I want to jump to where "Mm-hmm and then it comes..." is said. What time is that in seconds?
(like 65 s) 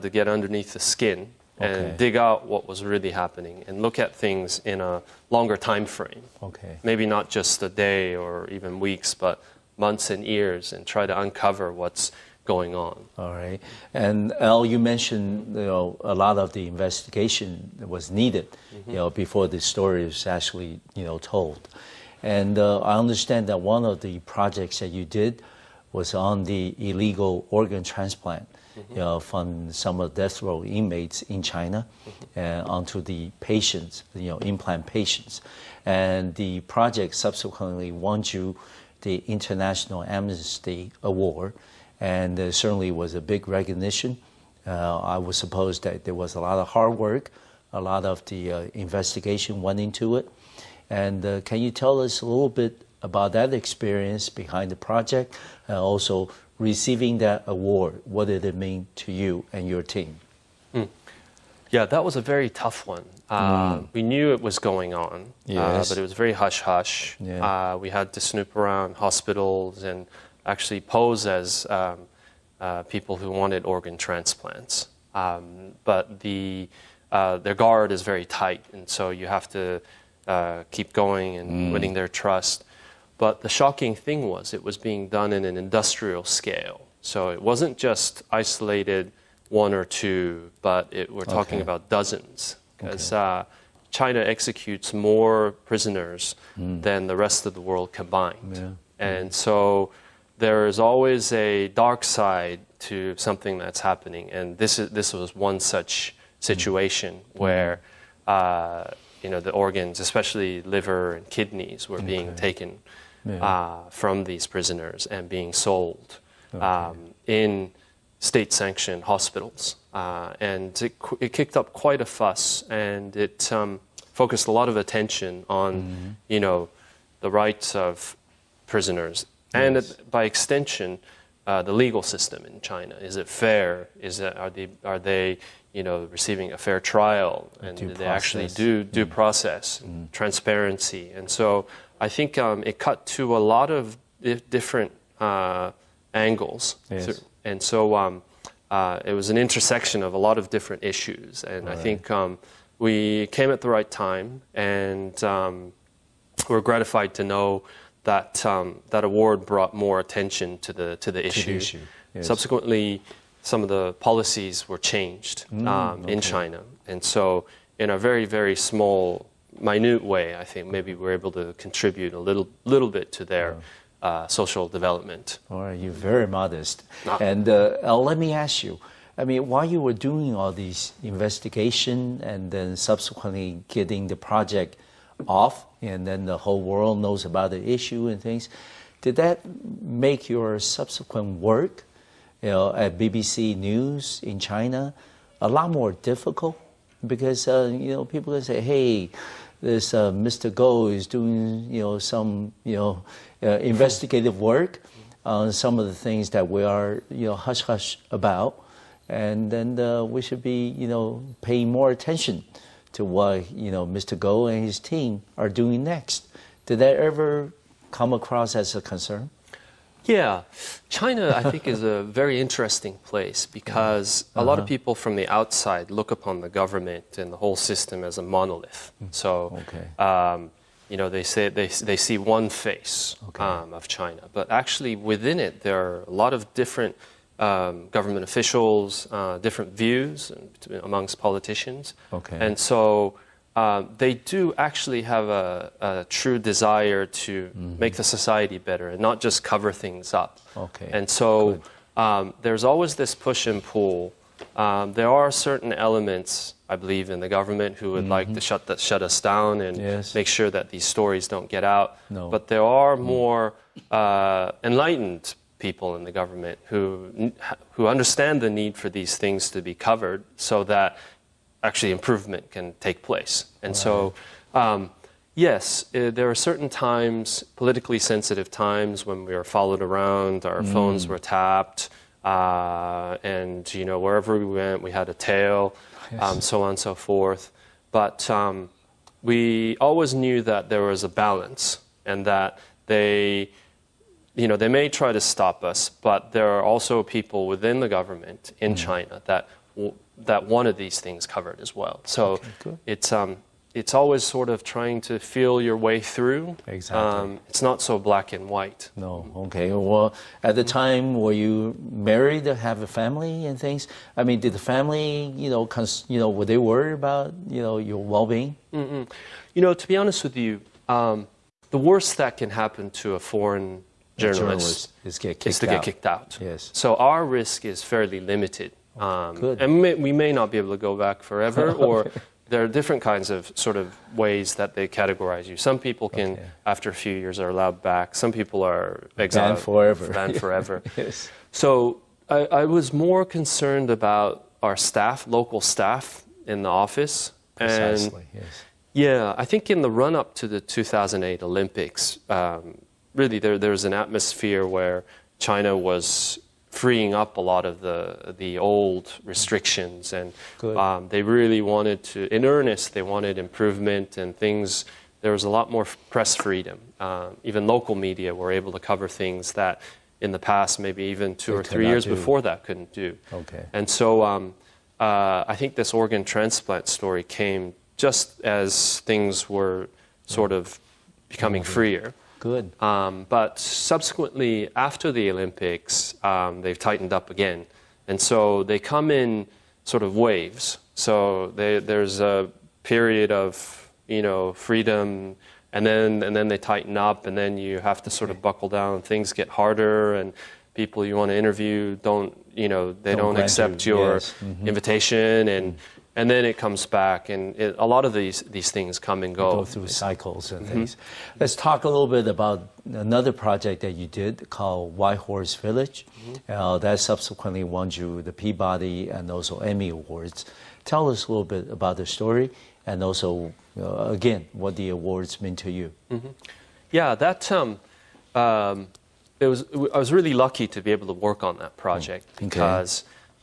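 405 s.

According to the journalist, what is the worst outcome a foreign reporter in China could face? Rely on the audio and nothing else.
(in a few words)
get kicked out.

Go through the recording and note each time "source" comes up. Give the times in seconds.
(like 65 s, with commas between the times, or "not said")
not said.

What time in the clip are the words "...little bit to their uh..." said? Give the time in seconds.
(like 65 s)
172 s.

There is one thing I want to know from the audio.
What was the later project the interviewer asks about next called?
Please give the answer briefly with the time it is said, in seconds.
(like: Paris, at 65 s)
White Horse Village, at 414 s.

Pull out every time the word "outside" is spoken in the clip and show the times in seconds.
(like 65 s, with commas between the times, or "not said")
225 s.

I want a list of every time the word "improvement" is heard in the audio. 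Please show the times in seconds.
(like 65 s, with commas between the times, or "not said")
271 s, 363 s.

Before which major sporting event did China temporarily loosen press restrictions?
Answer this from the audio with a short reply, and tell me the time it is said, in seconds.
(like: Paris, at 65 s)
2008 Olympics, at 350 s.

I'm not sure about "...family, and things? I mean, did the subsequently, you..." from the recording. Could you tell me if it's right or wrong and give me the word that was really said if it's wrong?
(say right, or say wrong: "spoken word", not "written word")
wrong: "family", not "subsequently".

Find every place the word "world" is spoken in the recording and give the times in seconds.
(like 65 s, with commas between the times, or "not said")
97 s, 186 s.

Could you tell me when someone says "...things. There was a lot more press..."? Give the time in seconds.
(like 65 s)
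364 s.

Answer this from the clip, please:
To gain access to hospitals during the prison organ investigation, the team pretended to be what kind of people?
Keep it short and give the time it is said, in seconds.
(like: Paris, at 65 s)
people who wanted organ transplants, at 72 s.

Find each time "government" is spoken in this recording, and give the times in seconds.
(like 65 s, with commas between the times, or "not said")
226 s, 237 s, 257 s, 266 s, 297 s.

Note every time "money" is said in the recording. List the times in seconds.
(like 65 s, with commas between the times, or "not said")
not said.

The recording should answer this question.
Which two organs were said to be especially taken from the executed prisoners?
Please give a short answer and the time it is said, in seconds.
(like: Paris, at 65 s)
liver and kidneys, at 110 s.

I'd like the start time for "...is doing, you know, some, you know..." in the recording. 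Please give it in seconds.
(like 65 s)
200 s.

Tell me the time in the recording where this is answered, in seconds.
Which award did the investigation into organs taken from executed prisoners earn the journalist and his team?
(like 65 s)
39 s.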